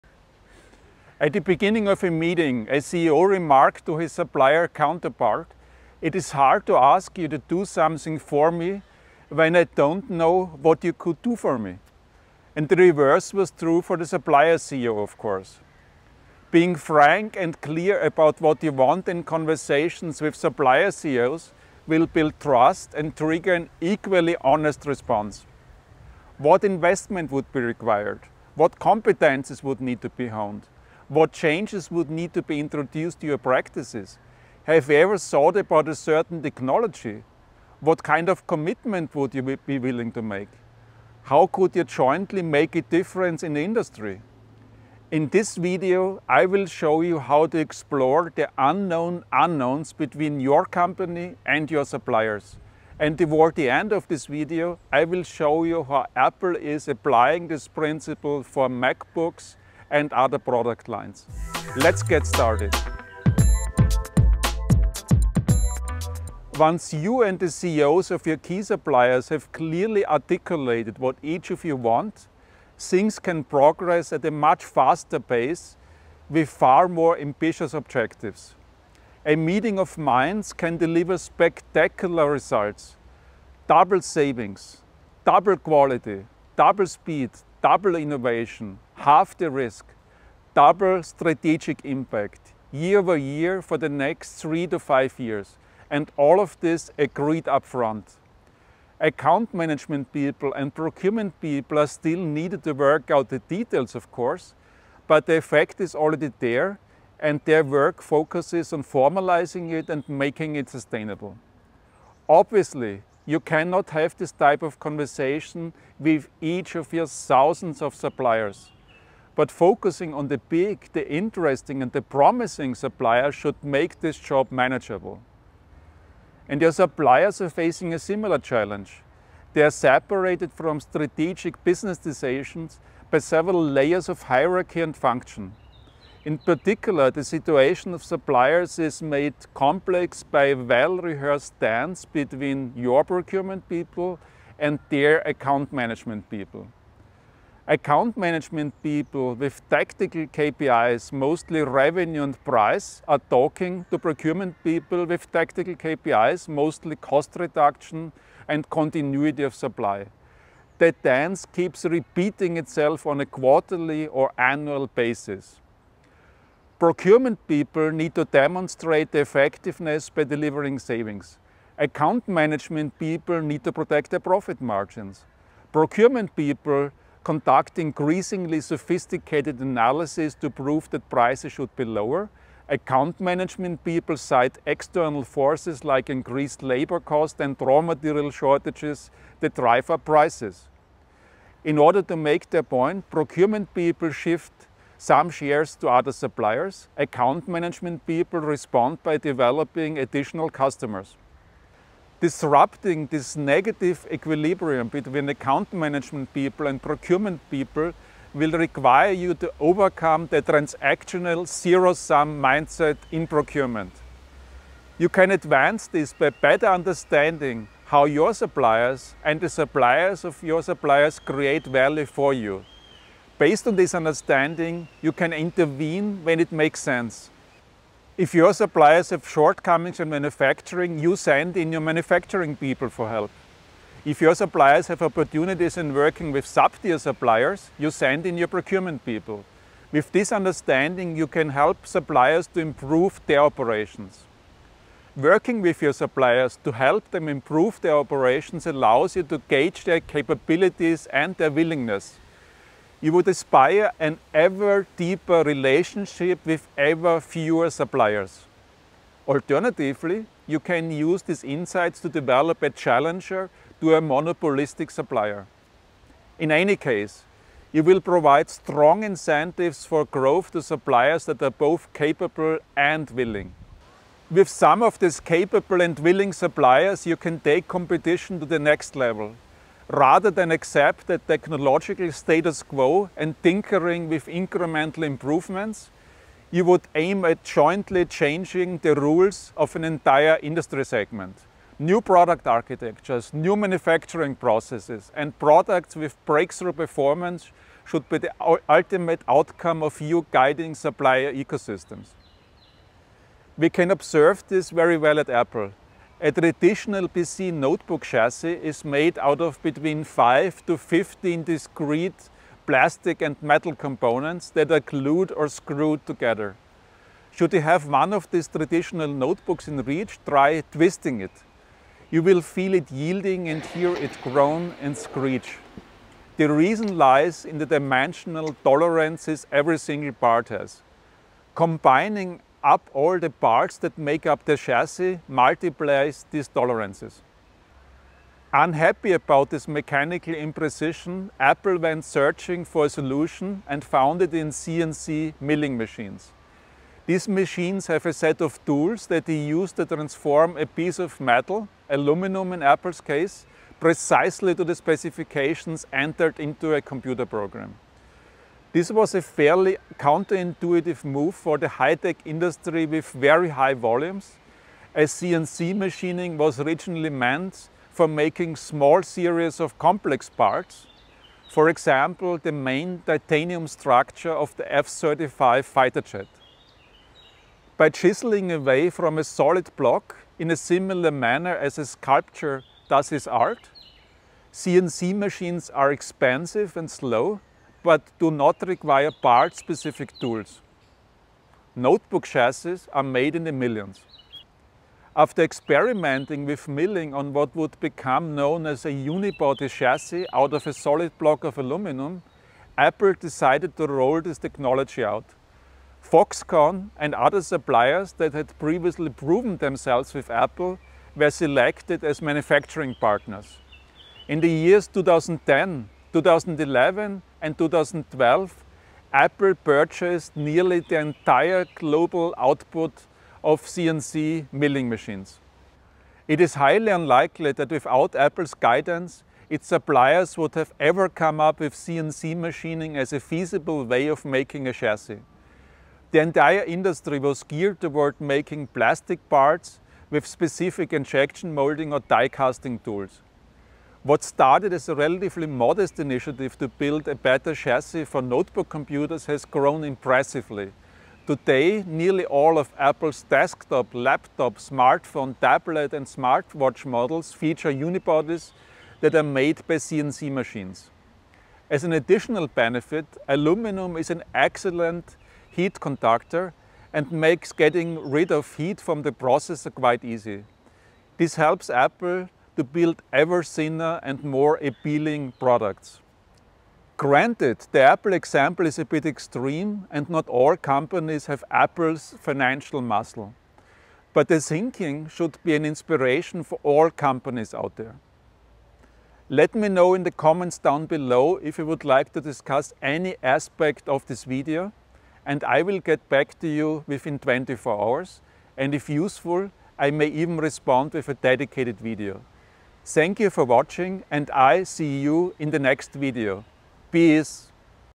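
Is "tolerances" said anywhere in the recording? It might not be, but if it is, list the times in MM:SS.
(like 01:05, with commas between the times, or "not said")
05:28, 05:36.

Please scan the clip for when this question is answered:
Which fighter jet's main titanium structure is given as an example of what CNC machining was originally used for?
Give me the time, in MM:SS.
06:14.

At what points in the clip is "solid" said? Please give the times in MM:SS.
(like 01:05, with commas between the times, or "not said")
06:19, 06:40.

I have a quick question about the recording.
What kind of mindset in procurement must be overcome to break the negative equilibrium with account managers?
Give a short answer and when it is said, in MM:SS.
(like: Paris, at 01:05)
transactional zero-sum mindset, at 03:30.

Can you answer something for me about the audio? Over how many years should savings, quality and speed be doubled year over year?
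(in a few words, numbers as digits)
3 to 5 years.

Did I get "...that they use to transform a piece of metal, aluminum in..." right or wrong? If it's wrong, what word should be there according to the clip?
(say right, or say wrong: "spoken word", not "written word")
right.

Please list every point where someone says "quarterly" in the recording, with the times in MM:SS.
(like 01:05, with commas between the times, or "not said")
02:43.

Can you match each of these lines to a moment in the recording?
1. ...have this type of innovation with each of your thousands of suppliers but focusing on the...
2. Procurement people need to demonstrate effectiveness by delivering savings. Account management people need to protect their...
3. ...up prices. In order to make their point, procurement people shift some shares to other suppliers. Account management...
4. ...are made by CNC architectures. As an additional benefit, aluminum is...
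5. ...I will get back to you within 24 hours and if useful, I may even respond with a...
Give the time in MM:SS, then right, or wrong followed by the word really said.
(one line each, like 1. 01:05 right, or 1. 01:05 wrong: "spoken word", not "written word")
1. 01:53 wrong: "conversation", not "innovation"
2. 02:46 right
3. 03:09 right
4. 07:39 wrong: "machines", not "architectures"
5. 08:15 right.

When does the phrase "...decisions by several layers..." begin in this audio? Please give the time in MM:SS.
02:11.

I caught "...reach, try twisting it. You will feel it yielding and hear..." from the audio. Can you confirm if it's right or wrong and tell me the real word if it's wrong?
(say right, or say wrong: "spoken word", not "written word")
right.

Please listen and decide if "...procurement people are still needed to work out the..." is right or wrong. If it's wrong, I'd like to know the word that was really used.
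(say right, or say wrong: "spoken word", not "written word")
right.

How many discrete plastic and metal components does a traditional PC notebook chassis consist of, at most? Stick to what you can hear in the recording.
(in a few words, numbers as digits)
15.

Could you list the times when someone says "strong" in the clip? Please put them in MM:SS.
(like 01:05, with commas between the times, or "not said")
04:28.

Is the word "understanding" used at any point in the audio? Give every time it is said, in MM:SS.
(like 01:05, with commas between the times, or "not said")
03:36, 03:43, 04:00.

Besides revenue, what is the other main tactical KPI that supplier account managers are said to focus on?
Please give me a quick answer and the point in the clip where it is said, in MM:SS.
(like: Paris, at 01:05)
price, at 02:32.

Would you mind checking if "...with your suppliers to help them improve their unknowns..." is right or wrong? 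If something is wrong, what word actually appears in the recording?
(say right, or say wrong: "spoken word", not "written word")
wrong: "operations", not "unknowns".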